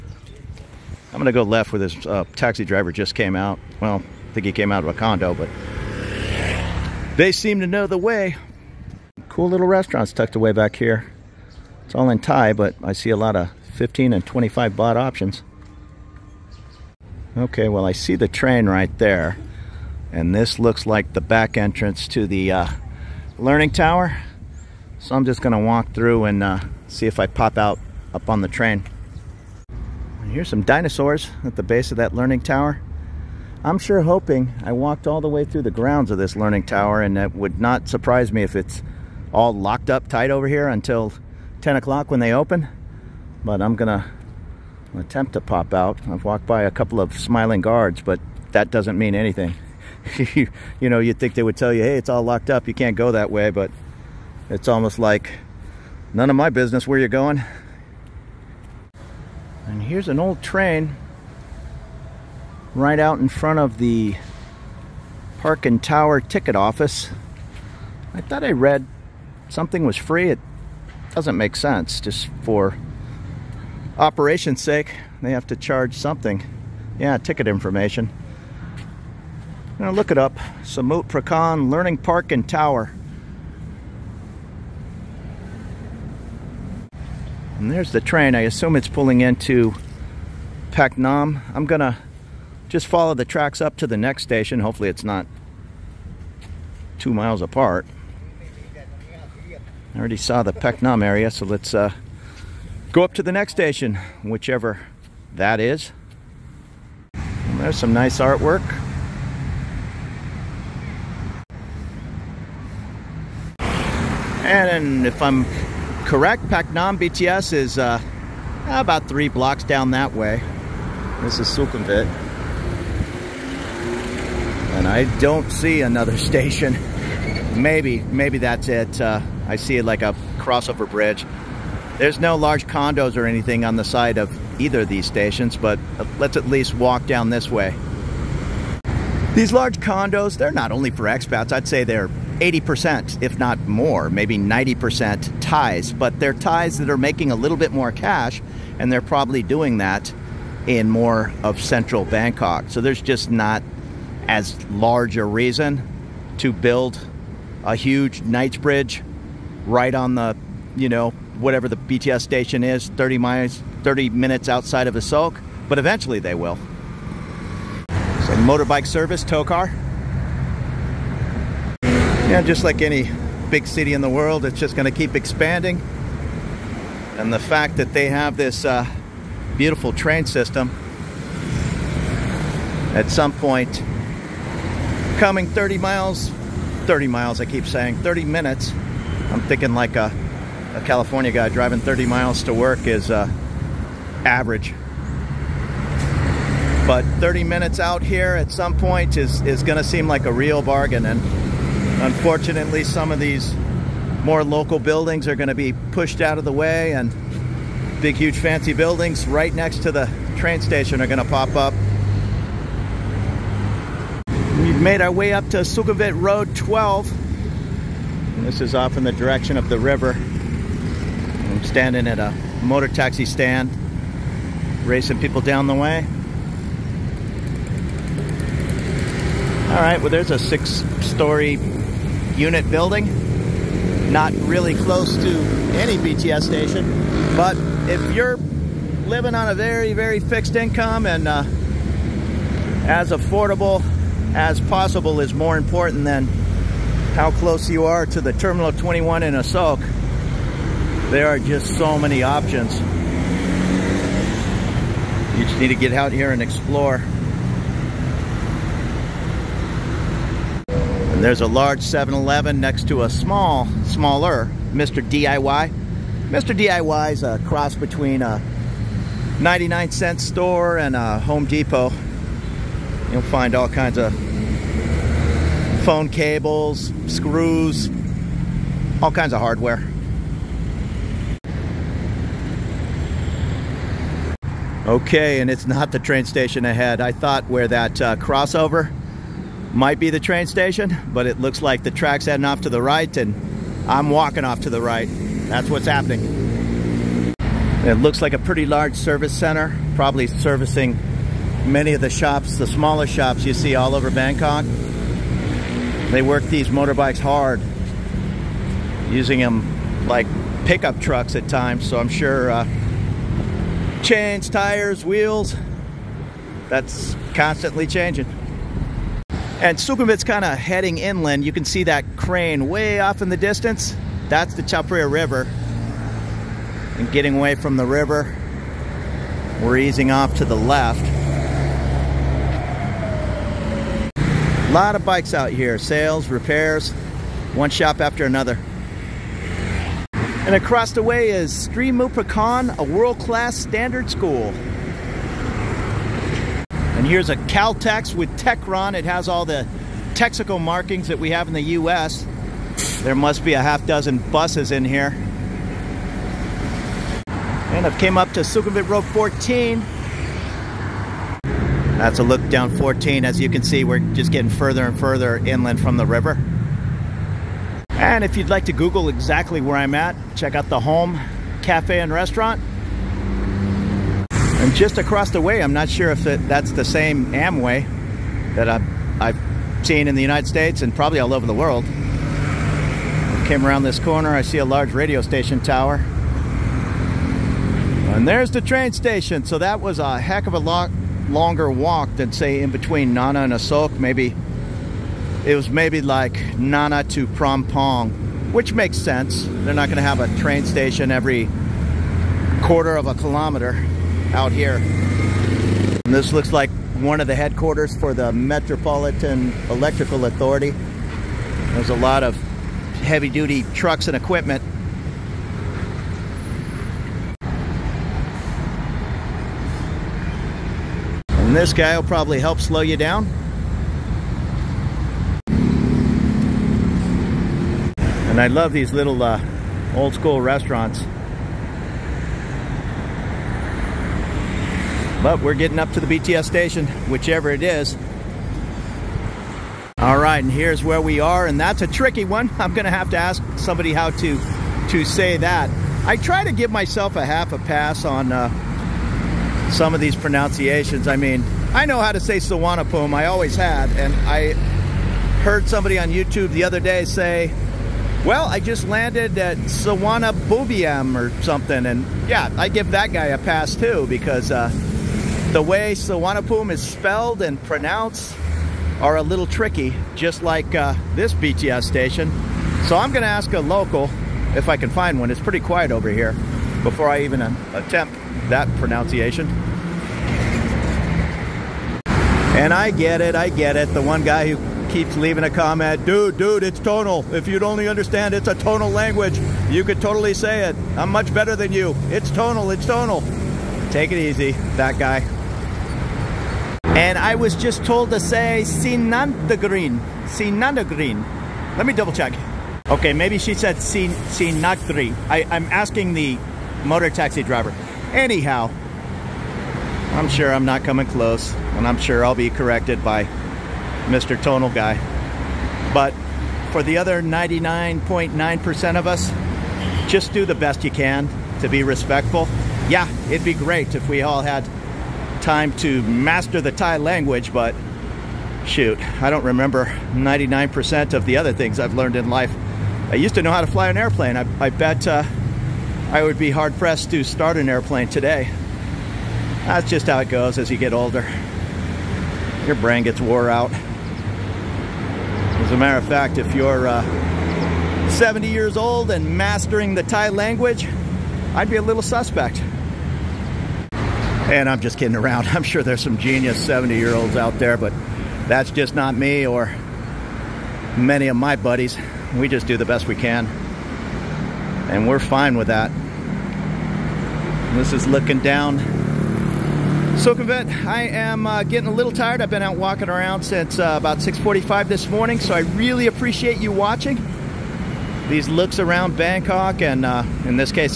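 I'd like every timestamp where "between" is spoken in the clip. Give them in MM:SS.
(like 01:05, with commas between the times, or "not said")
04:27, 06:32.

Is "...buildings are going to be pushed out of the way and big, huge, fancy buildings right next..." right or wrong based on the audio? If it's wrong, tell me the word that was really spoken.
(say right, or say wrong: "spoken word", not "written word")
right.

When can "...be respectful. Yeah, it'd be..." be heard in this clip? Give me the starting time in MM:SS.
08:41.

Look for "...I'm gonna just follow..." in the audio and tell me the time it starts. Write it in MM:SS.
01:31.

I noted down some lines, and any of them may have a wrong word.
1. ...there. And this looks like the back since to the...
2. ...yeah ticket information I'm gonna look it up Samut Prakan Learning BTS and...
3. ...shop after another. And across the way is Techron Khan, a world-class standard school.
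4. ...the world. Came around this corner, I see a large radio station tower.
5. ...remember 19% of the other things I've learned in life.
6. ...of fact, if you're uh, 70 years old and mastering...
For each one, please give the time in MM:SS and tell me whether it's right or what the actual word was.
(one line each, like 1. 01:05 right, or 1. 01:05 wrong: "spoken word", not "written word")
1. 00:18 wrong: "entrance", not "since"
2. 01:16 wrong: "Park", not "BTS"
3. 05:37 wrong: "Streamu", not "Techron"
4. 06:21 right
5. 08:49 wrong: "99", not "19"
6. 09:05 right.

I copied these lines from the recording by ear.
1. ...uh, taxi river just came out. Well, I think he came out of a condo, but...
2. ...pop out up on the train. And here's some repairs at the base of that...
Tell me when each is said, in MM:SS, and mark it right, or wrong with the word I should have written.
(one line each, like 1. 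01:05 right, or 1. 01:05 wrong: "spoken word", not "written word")
1. 00:02 wrong: "driver", not "river"
2. 00:27 wrong: "dinosaurs", not "repairs".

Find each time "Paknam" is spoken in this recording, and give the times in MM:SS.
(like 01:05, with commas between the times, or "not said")
01:30, 01:56.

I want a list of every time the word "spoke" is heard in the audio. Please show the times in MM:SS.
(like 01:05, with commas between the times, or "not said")
not said.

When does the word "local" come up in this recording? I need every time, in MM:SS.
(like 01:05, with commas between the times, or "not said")
03:24, 07:53.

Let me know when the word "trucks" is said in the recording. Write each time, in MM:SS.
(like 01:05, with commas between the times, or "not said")
05:10, 06:53.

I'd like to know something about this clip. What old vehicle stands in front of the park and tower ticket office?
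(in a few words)
An old train.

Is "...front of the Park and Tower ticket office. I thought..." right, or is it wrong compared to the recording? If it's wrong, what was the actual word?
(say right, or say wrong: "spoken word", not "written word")
right.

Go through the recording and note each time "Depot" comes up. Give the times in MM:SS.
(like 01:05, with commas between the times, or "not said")
04:31.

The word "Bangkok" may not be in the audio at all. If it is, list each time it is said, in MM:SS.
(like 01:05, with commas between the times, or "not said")
02:32, 05:04, 09:39.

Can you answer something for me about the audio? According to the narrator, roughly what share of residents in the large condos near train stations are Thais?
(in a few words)
80%.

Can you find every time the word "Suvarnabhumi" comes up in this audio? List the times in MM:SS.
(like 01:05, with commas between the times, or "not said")
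07:32, 07:45.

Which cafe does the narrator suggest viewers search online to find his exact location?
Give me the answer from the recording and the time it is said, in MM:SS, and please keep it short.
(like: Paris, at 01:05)
Home cafe and restaurant, at 06:10.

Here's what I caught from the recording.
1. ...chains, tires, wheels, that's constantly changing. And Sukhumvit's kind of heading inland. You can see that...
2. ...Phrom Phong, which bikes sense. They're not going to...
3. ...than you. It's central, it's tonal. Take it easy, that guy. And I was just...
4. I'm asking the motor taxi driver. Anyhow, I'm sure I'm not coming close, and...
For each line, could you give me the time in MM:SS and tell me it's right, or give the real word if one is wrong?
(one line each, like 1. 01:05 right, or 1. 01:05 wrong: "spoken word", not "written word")
1. 05:14 right
2. 06:37 wrong: "makes", not "bikes"
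3. 08:11 wrong: "tonal", not "central"
4. 08:25 right.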